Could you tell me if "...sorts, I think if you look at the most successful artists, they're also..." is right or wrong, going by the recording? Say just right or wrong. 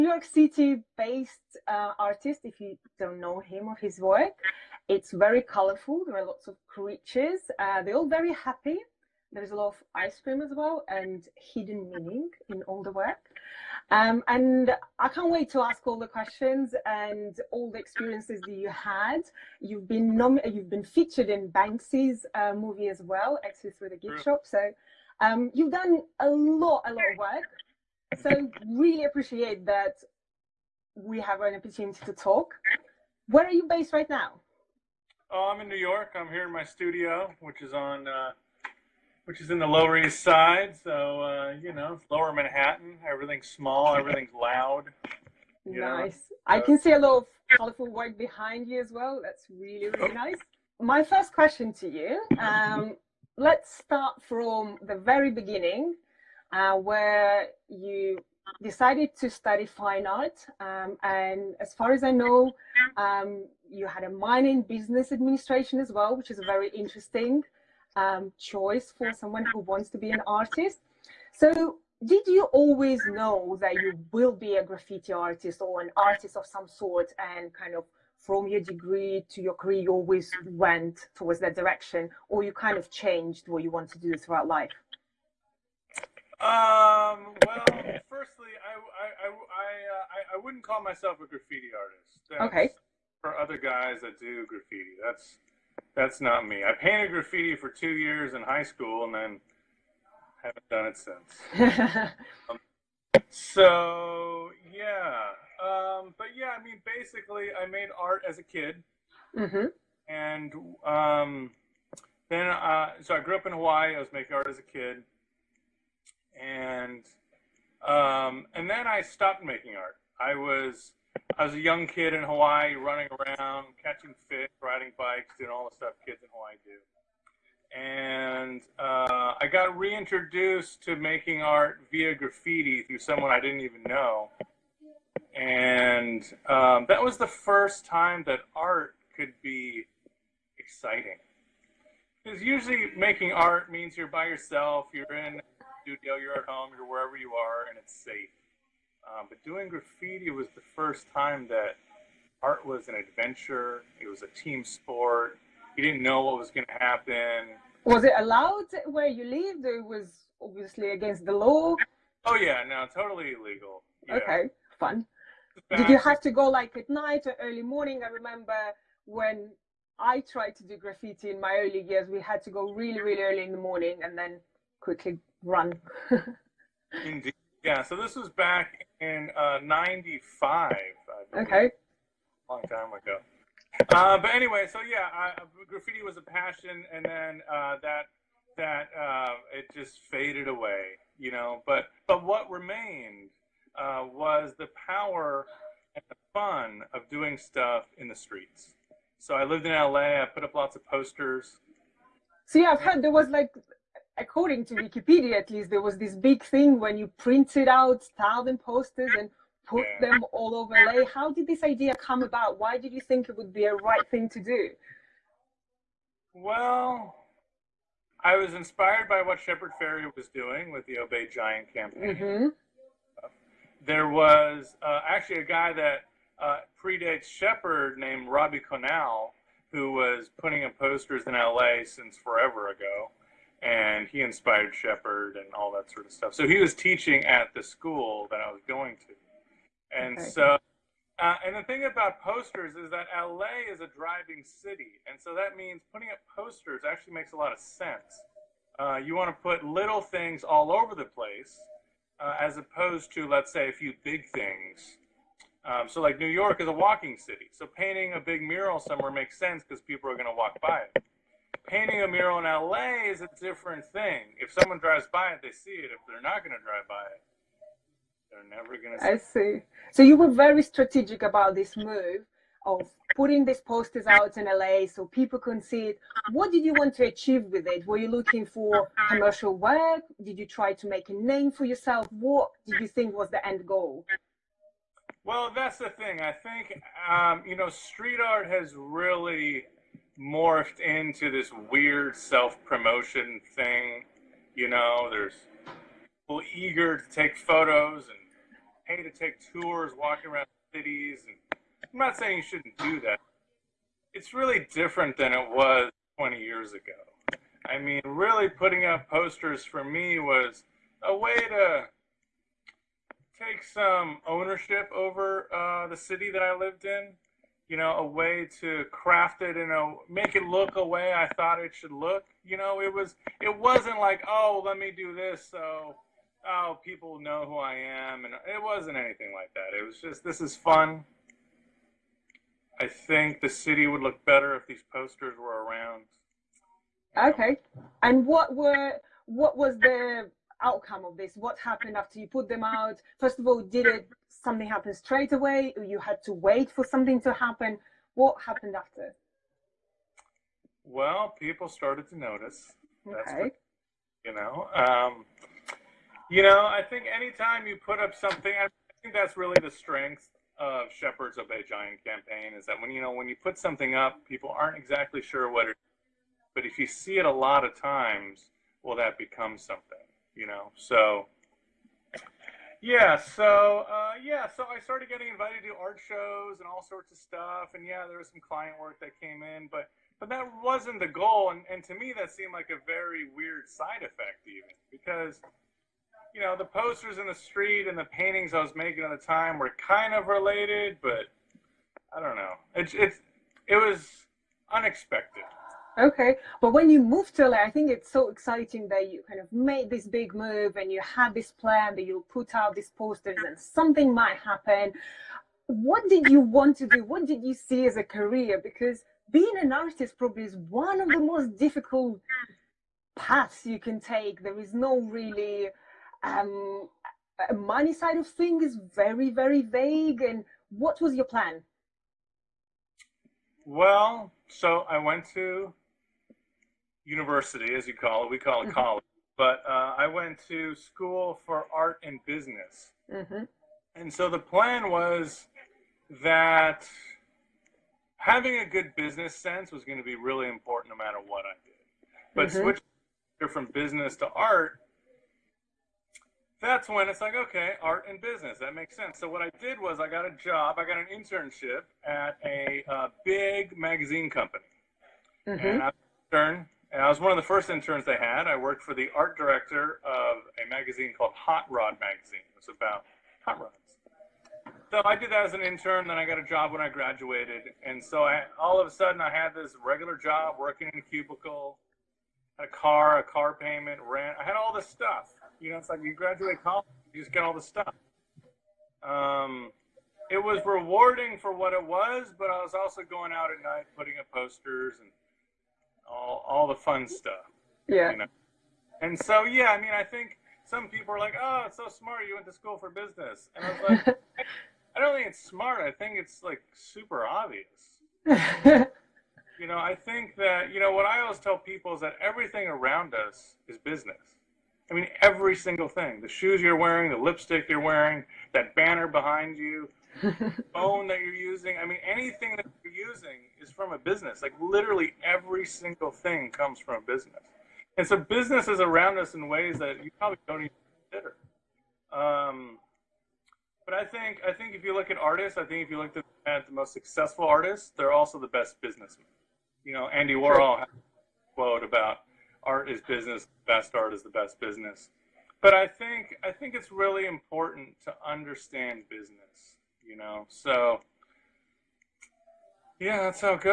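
wrong.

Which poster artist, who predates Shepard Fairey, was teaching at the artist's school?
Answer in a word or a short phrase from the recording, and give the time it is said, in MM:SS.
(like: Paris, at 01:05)
Robbie Conal, at 03:48.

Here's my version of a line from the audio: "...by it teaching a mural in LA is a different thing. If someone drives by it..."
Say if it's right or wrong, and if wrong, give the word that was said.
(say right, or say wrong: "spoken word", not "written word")
wrong: "painting", not "teaching".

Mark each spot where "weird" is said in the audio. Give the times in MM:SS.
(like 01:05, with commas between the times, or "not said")
04:51, 06:23.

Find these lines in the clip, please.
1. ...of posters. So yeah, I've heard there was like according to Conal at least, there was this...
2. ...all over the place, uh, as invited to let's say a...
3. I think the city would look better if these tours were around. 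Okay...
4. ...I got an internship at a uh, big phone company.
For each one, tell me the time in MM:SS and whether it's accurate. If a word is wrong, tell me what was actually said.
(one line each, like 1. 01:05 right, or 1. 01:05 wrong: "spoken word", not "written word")
1. 03:20 wrong: "Wikipedia", not "Conal"
2. 04:10 wrong: "opposed", not "invited"
3. 05:32 wrong: "posters", not "tours"
4. 07:30 wrong: "magazine", not "phone".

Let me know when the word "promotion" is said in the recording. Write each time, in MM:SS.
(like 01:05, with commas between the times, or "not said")
04:52.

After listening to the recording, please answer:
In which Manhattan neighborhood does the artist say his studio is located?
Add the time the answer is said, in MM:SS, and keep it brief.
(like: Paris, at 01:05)
Lower East Side, at 00:39.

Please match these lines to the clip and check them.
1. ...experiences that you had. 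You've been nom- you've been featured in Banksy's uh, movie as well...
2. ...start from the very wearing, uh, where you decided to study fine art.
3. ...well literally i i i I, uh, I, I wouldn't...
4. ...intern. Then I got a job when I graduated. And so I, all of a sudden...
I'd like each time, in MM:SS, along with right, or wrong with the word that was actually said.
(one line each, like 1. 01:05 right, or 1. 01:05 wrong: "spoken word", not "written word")
1. 00:17 right
2. 00:53 wrong: "beginning", not "wearing"
3. 01:27 wrong: "firstly", not "literally"
4. 07:45 right.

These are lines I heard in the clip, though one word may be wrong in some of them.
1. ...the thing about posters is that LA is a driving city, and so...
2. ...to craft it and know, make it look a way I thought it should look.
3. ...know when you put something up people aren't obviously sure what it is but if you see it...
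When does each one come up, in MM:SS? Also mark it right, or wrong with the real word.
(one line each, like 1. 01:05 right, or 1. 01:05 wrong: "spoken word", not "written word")
1. 04:01 right
2. 05:18 right
3. 06:03 wrong: "exactly", not "obviously".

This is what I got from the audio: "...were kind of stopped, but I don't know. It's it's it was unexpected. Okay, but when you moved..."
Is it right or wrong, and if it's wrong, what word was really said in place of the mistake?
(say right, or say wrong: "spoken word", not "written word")
wrong: "related", not "stopped".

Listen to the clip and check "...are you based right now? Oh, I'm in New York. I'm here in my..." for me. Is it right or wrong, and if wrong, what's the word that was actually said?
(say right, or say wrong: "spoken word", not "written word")
right.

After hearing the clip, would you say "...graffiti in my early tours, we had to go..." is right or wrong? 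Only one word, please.
wrong.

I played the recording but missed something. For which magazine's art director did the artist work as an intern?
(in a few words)
Hot Rod Magazine.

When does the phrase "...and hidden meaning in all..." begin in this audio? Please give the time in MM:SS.
00:10.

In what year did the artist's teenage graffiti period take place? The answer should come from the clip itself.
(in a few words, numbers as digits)
1995.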